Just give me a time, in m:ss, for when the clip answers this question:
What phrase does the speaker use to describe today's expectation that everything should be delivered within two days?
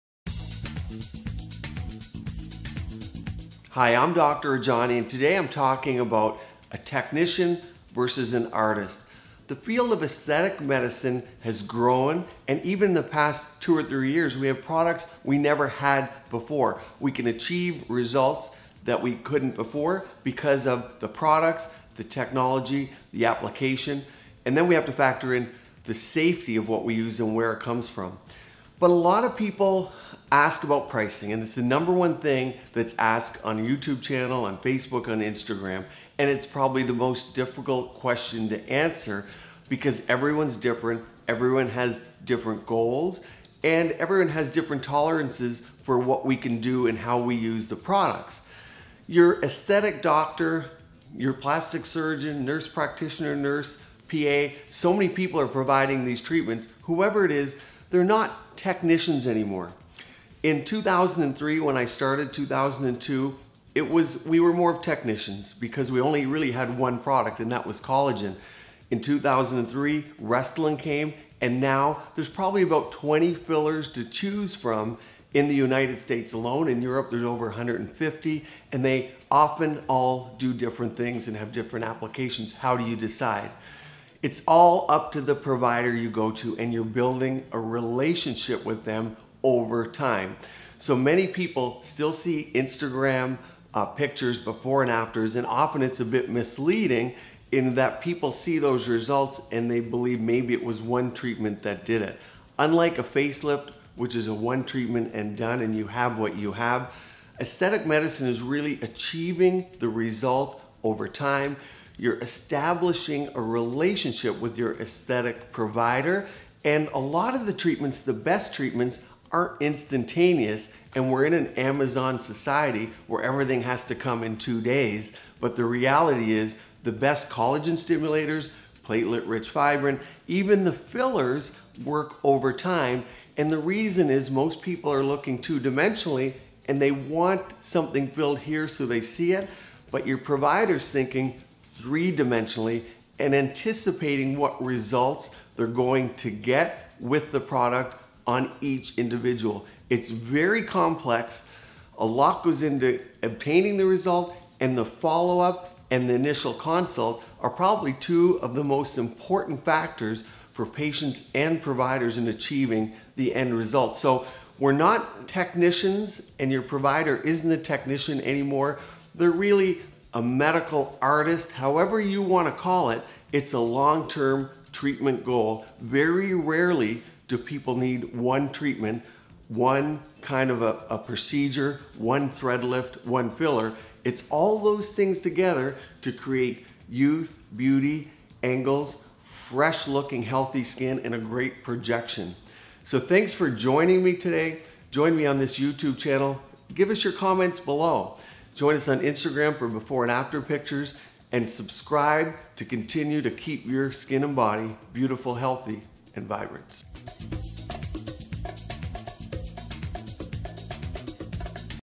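2:01.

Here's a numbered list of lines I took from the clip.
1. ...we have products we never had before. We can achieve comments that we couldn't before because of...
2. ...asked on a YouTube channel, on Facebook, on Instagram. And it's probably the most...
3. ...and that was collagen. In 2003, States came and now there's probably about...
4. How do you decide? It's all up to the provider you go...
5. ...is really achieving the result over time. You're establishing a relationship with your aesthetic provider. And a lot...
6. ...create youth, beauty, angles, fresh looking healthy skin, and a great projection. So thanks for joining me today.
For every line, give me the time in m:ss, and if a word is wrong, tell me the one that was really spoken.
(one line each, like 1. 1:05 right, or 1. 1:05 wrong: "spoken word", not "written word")
1. 0:14 wrong: "results", not "comments"
2. 0:32 right
3. 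1:07 wrong: "Restylane", not "States"
4. 1:22 right
5. 1:48 right
6. 3:06 right.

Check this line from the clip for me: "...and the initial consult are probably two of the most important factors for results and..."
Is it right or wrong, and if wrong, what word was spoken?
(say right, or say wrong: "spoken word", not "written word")
wrong: "patients", not "results".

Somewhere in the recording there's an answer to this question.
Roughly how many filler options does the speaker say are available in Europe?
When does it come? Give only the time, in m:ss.
1:17.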